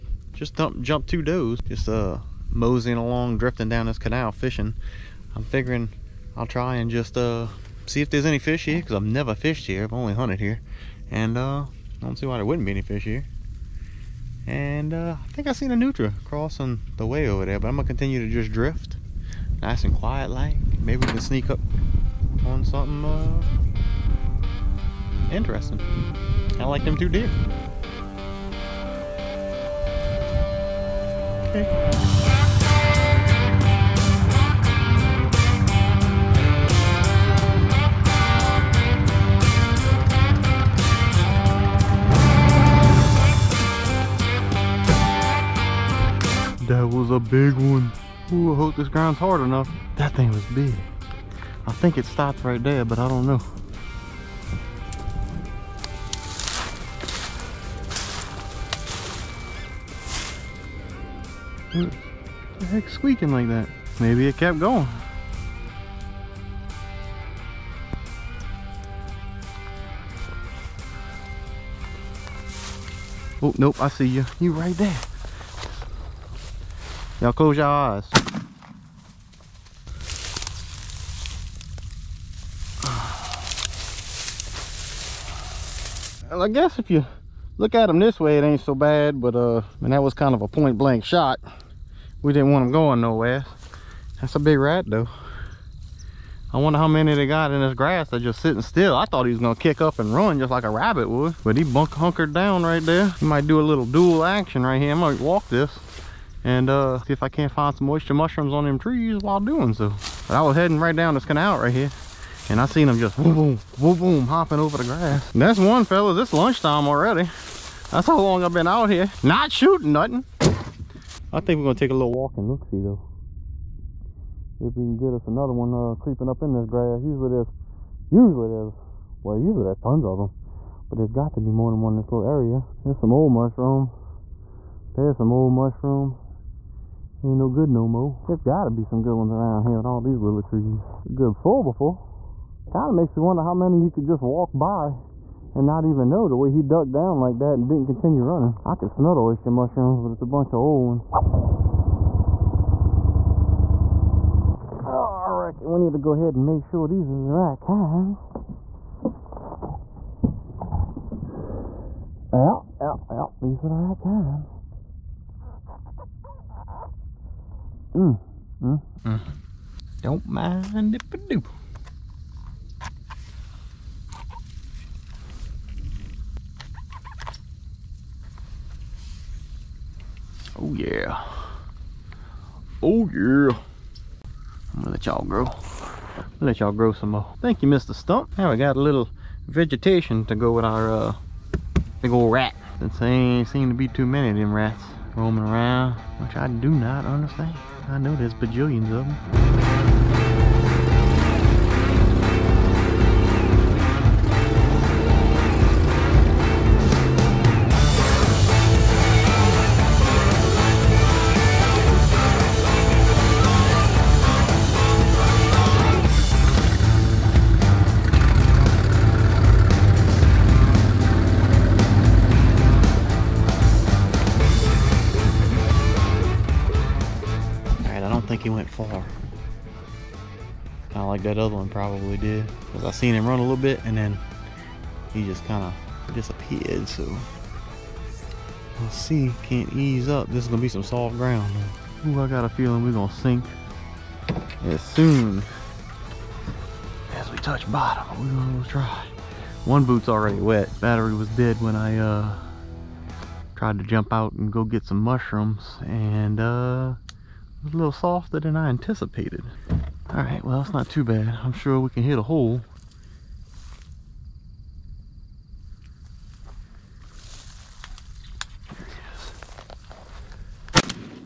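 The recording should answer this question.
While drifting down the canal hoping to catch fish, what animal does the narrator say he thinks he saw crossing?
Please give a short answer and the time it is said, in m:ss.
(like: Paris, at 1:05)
Nutria, at 0:15.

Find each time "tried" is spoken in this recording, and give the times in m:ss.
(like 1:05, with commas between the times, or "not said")
4:13.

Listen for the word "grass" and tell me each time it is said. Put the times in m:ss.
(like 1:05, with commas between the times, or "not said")
1:37, 1:54, 2:06.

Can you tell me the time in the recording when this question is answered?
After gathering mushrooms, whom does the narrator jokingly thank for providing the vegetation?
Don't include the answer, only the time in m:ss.
3:07.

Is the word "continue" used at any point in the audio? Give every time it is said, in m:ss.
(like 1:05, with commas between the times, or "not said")
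0:17, 2:27.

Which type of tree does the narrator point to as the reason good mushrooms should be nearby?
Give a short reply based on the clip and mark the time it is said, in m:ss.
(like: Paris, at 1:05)
willow trees, at 2:20.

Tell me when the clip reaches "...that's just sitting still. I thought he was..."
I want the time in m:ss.
1:38.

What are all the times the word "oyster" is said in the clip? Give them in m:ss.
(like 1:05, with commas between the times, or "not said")
1:47, 2:29.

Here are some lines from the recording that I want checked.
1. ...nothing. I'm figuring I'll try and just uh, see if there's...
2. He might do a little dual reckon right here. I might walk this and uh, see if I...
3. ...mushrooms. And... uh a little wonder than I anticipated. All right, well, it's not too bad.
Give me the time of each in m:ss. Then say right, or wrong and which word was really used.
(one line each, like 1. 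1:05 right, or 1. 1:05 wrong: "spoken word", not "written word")
1. 0:04 wrong: "fishing", not "nothing"
2. 1:43 wrong: "action", not "reckon"
3. 4:14 wrong: "softer", not "wonder".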